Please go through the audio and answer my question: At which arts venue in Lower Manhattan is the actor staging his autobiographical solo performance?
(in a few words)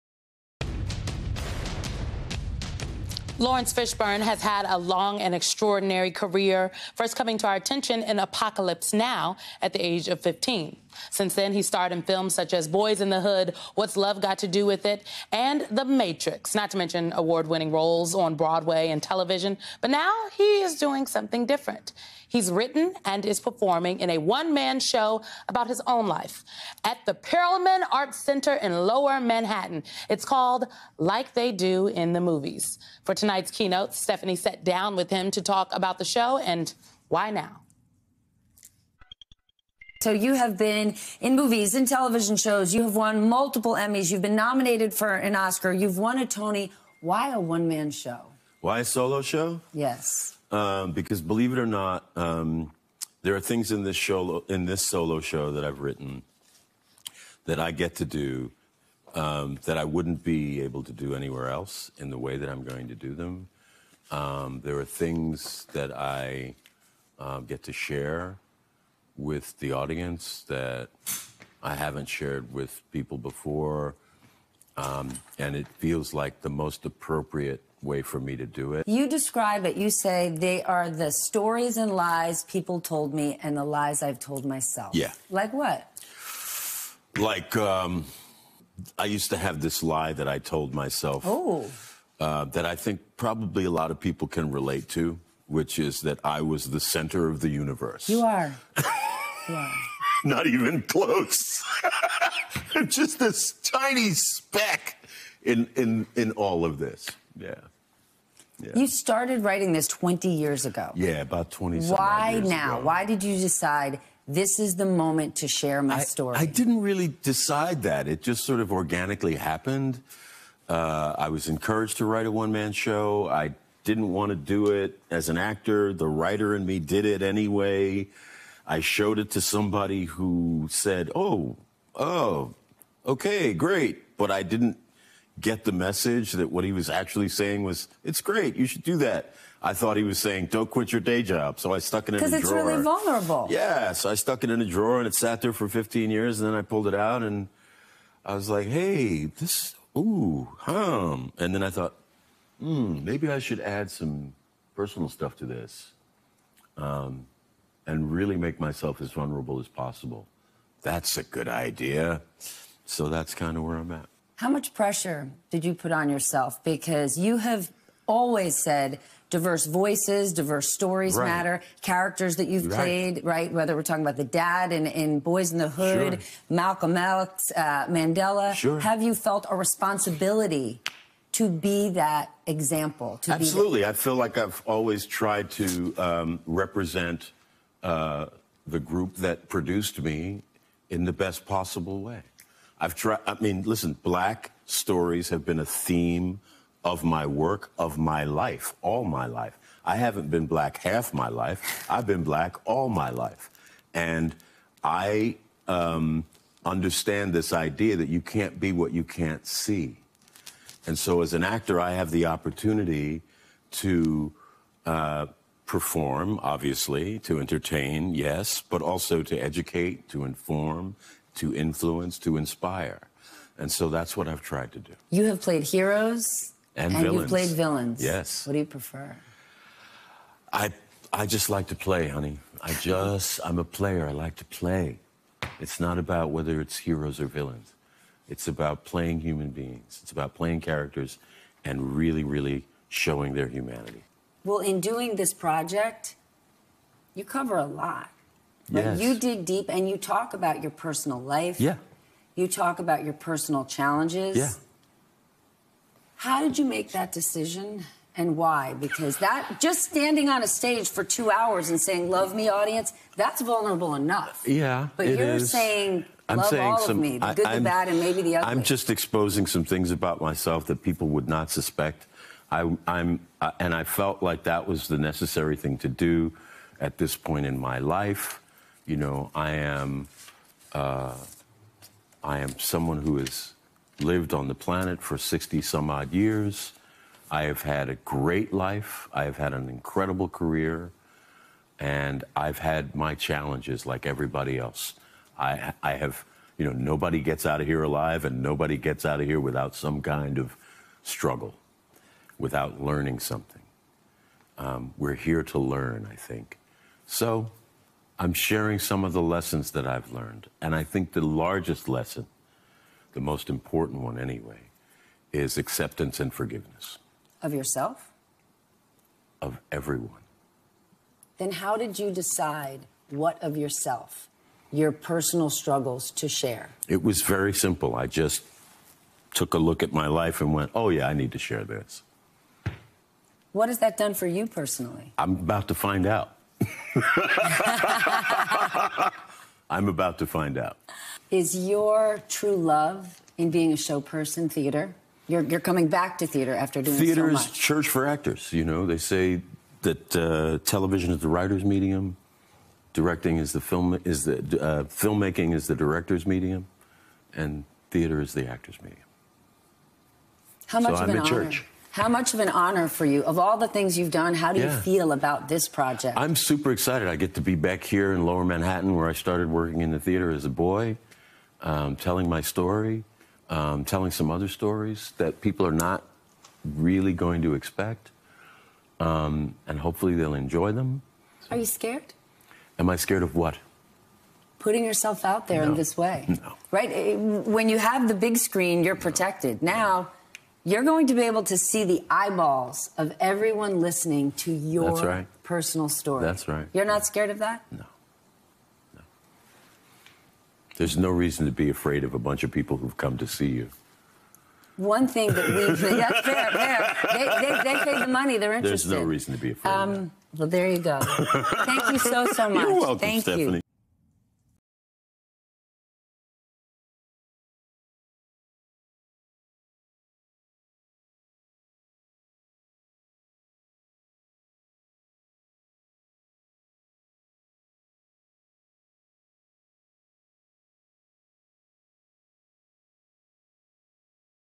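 Perelman Arts Center.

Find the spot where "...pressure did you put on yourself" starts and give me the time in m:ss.
2:44.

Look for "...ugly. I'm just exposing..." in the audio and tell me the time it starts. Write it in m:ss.
4:28.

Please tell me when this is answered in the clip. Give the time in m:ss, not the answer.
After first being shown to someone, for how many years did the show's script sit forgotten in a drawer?
2:25.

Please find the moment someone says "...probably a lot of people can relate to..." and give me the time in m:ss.
1:33.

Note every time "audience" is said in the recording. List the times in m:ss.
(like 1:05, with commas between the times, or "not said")
1:09, 4:22.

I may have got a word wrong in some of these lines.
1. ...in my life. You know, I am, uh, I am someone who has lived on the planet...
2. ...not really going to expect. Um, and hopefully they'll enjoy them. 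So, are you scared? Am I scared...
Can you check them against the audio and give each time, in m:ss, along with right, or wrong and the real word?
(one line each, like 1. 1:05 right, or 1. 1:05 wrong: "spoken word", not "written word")
1. 4:37 right
2. 6:15 right.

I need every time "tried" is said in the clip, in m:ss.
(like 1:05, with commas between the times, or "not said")
3:05, 3:12, 3:44.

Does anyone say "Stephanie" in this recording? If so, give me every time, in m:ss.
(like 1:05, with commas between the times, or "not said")
0:33, 6:53.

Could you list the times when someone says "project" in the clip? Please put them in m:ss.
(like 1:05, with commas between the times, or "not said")
4:05, 6:05.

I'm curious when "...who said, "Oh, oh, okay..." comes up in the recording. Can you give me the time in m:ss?
2:10.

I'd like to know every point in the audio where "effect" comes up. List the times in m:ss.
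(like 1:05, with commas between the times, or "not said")
not said.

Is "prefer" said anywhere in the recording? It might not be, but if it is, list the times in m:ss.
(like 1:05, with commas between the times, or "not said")
3:48.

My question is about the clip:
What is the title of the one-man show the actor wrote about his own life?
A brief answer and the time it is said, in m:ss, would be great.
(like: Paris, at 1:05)
Like They Do in the Movies, at 0:30.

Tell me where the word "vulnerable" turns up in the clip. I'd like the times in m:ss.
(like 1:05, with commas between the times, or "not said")
2:22, 2:39, 4:23.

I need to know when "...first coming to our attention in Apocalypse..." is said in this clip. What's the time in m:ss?
0:06.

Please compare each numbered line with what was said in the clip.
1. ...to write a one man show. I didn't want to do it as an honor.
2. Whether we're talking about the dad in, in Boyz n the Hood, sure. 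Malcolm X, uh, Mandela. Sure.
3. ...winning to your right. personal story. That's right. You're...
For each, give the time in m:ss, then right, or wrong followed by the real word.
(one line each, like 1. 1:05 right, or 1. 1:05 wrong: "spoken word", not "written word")
1. 2:01 wrong: "actor", not "honor"
2. 2:53 right
3. 6:33 wrong: "listening", not "winning".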